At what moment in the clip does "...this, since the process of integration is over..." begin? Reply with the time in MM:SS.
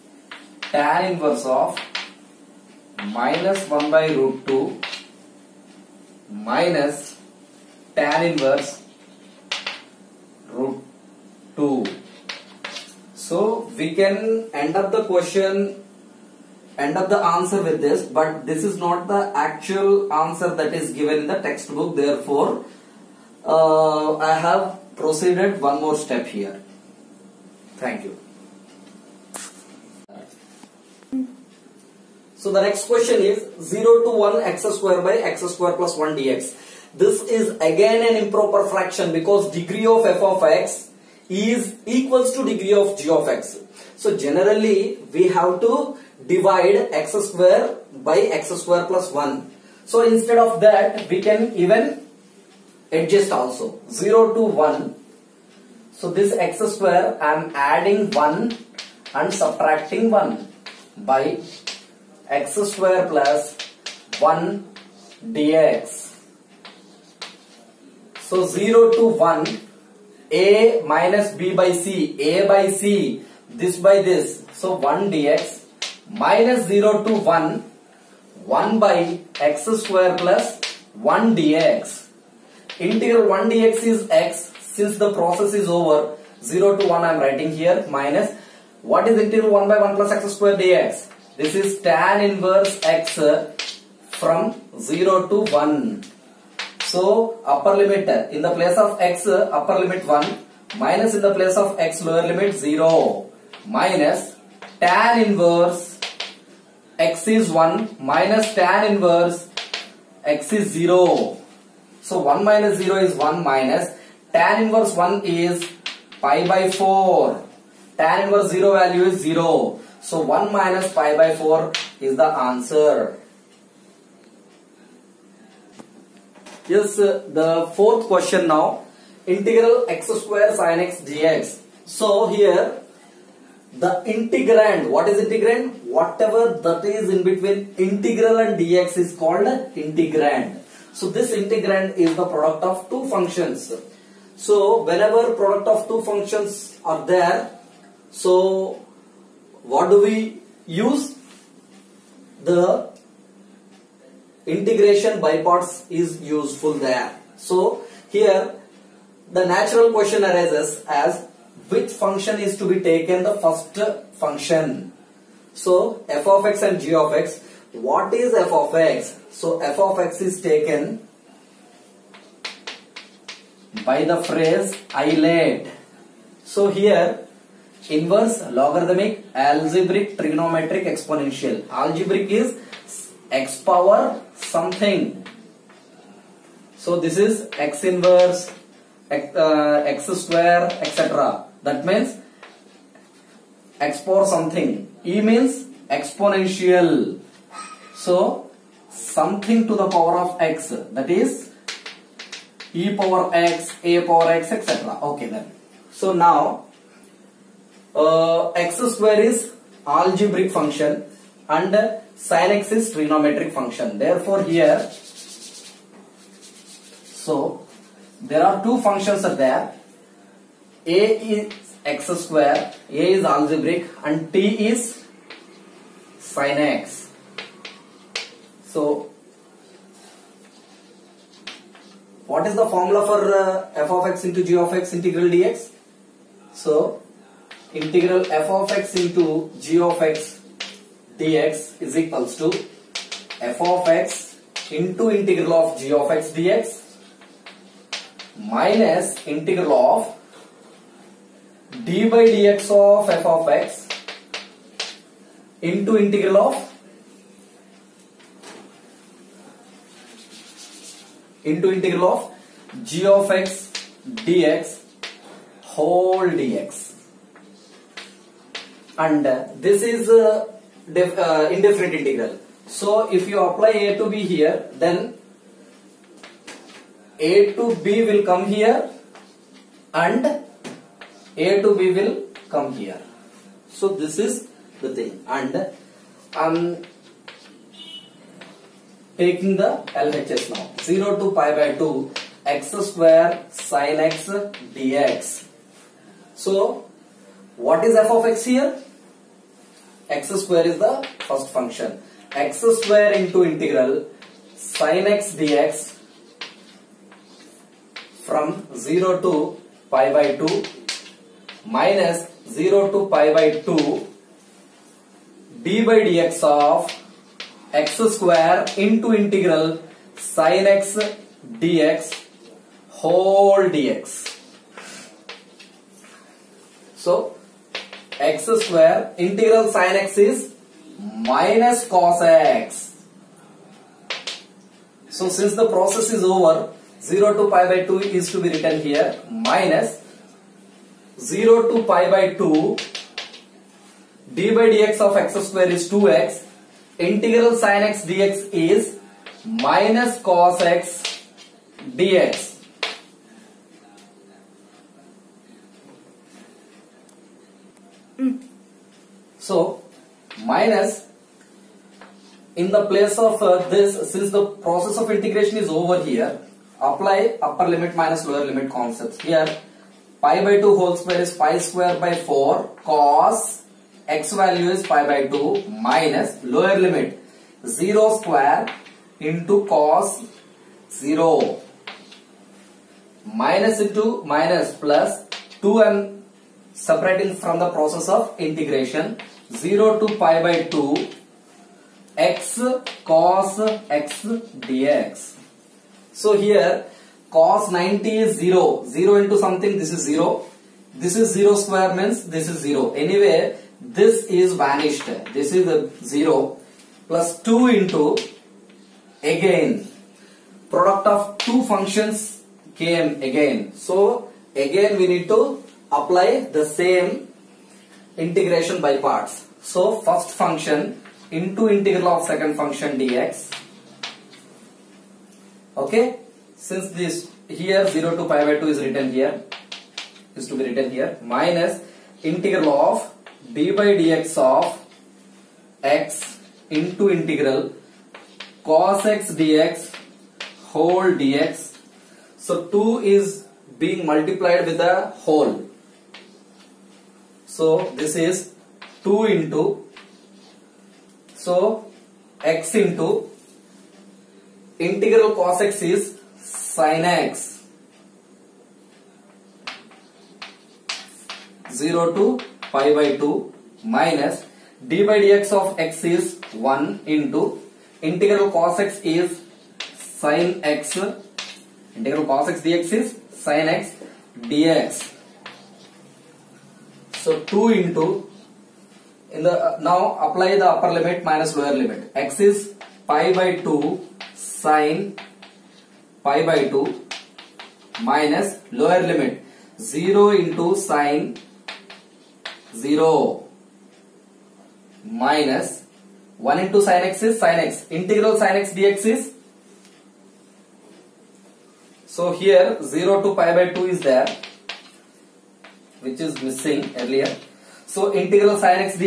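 06:03.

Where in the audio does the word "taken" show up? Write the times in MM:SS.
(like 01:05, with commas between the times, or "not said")
02:42, 02:50.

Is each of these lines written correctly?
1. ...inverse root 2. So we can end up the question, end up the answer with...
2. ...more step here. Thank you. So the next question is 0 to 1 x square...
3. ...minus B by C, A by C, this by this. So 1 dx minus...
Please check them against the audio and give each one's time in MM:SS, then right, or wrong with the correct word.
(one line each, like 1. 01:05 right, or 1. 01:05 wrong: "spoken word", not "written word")
1. 00:08 right
2. 00:25 right
3. 01:10 right.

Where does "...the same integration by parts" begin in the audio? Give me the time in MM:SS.
06:56.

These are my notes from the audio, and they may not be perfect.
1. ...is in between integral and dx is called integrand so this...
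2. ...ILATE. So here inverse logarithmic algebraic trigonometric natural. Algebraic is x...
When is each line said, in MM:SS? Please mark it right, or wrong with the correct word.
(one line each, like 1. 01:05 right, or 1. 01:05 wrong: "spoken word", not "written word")
1. 02:16 right
2. 02:54 wrong: "exponential", not "natural".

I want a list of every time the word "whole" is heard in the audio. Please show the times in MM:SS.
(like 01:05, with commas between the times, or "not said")
04:25, 05:22, 06:10, 07:20, 07:25.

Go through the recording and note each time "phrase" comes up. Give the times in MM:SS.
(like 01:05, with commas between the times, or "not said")
02:54.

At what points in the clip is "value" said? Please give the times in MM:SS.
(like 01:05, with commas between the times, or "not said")
01:58, 06:14.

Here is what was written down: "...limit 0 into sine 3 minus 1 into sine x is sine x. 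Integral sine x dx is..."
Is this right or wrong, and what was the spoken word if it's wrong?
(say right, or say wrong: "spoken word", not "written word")
wrong: "0", not "3".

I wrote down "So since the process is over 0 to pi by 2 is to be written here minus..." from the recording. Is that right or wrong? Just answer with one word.
right.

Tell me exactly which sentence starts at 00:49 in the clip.
So instead of that we can even adjust also 0 to 1.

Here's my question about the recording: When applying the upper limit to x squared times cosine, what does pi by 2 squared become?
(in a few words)
pi square by 4.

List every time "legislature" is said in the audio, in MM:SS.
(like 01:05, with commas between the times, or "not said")
not said.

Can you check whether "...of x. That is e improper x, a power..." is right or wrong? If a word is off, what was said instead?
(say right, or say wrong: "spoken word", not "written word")
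wrong: "power", not "improper".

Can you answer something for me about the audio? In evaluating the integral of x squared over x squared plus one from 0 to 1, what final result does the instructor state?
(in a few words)
1 minus pi by 4.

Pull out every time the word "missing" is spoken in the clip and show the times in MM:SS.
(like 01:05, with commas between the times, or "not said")
08:26.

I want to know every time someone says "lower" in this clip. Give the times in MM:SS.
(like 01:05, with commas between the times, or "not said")
01:42, 06:08, 06:16, 08:01, 08:08.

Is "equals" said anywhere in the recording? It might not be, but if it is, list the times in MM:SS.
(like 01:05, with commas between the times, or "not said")
00:41, 04:02.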